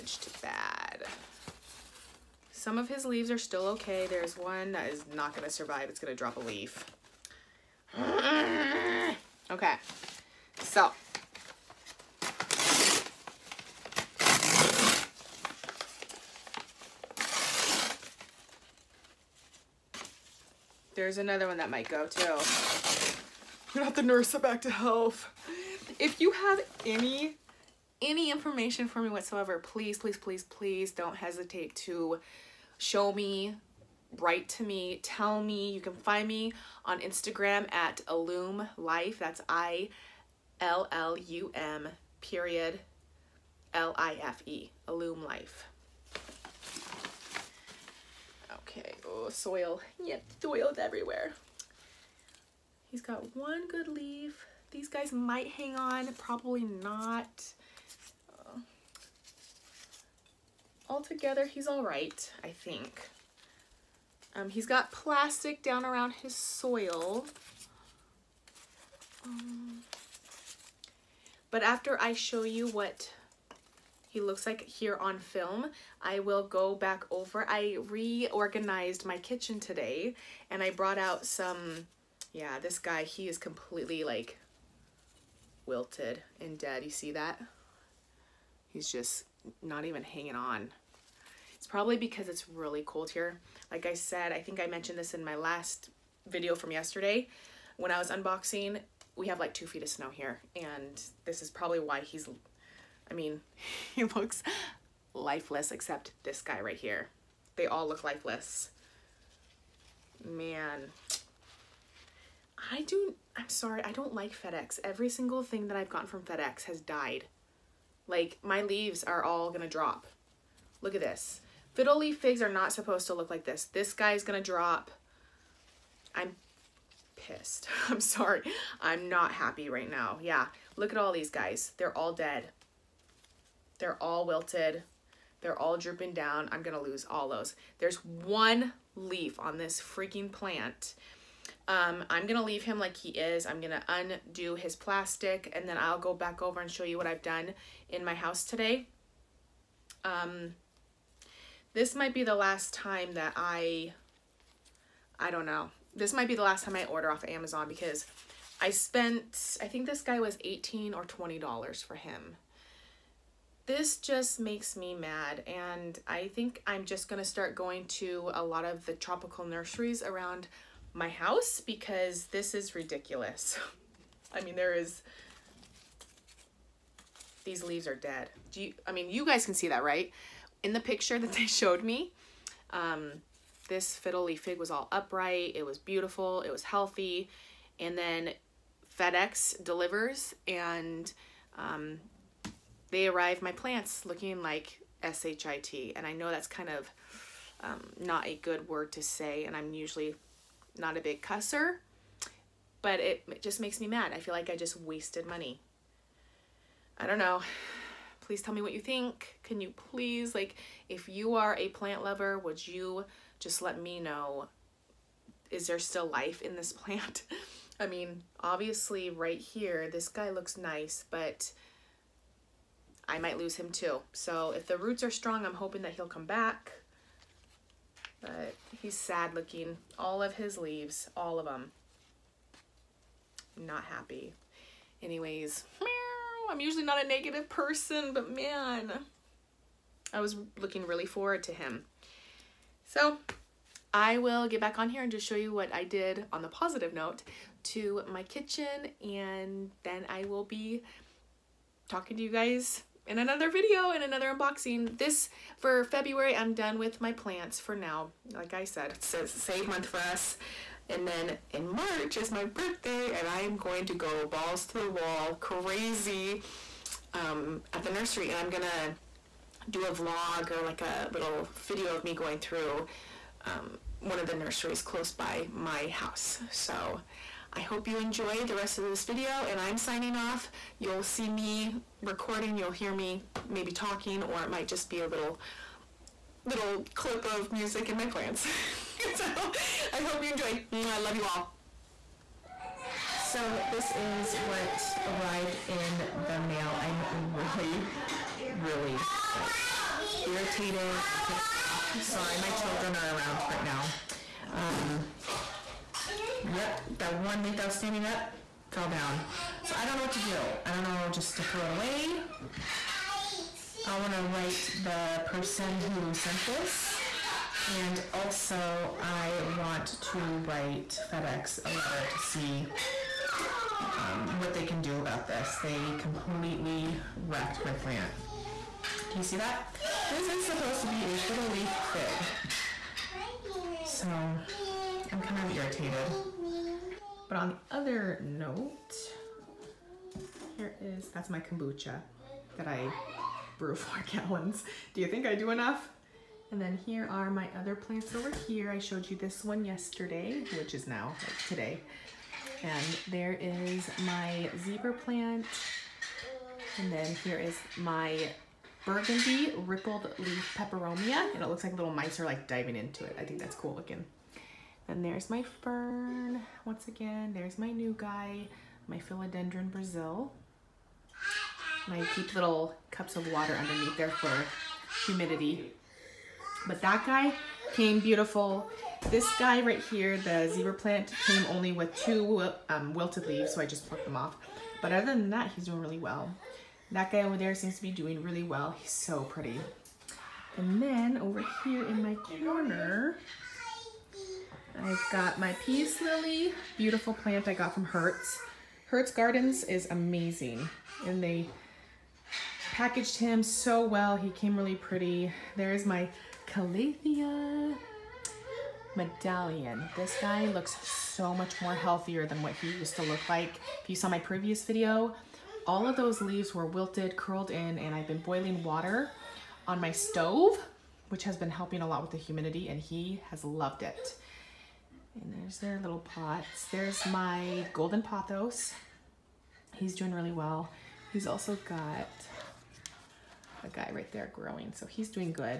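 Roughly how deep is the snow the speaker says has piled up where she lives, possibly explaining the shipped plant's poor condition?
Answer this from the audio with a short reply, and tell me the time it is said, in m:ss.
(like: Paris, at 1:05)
2 feet, at 1:39.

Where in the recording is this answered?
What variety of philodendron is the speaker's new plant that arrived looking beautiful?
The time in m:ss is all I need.
6:08.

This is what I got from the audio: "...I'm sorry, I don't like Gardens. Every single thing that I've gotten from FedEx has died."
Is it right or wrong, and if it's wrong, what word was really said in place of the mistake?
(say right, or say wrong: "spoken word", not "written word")
wrong: "FedEx", not "Gardens".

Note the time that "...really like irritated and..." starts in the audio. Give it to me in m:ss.
4:58.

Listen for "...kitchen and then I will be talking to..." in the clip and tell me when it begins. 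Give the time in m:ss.
4:08.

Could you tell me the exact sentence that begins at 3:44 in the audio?
So if the roots are strong, I'm hoping that he'll come back.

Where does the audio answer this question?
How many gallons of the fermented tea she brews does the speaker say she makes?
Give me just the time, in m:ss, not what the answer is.
5:43.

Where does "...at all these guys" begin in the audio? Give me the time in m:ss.
2:10.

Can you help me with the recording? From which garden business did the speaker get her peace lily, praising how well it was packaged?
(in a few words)
Hirt's Gardens.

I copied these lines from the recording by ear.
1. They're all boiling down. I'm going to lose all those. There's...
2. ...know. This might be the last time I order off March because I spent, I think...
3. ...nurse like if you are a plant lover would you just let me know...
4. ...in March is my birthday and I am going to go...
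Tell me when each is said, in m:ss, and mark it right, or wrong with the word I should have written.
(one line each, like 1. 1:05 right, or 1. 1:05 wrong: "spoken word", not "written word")
1. 2:15 wrong: "drooping", not "boiling"
2. 2:35 wrong: "Amazon", not "March"
3. 3:29 wrong: "please", not "nurse"
4. 4:21 right.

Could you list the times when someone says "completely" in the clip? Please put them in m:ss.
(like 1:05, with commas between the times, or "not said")
1:23, 5:25.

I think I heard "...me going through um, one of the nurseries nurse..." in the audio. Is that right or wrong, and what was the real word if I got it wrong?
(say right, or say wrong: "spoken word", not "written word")
wrong: "close", not "nurse".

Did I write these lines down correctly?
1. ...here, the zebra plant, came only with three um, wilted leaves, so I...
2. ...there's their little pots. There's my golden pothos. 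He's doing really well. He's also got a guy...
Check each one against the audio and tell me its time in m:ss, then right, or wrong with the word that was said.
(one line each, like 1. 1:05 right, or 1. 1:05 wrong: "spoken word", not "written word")
1. 6:19 wrong: "two", not "three"
2. 7:05 right.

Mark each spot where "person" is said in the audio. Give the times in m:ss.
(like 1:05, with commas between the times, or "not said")
3:57, 5:15.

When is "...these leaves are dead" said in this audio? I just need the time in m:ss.
2:57.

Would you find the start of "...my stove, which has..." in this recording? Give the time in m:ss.
6:59.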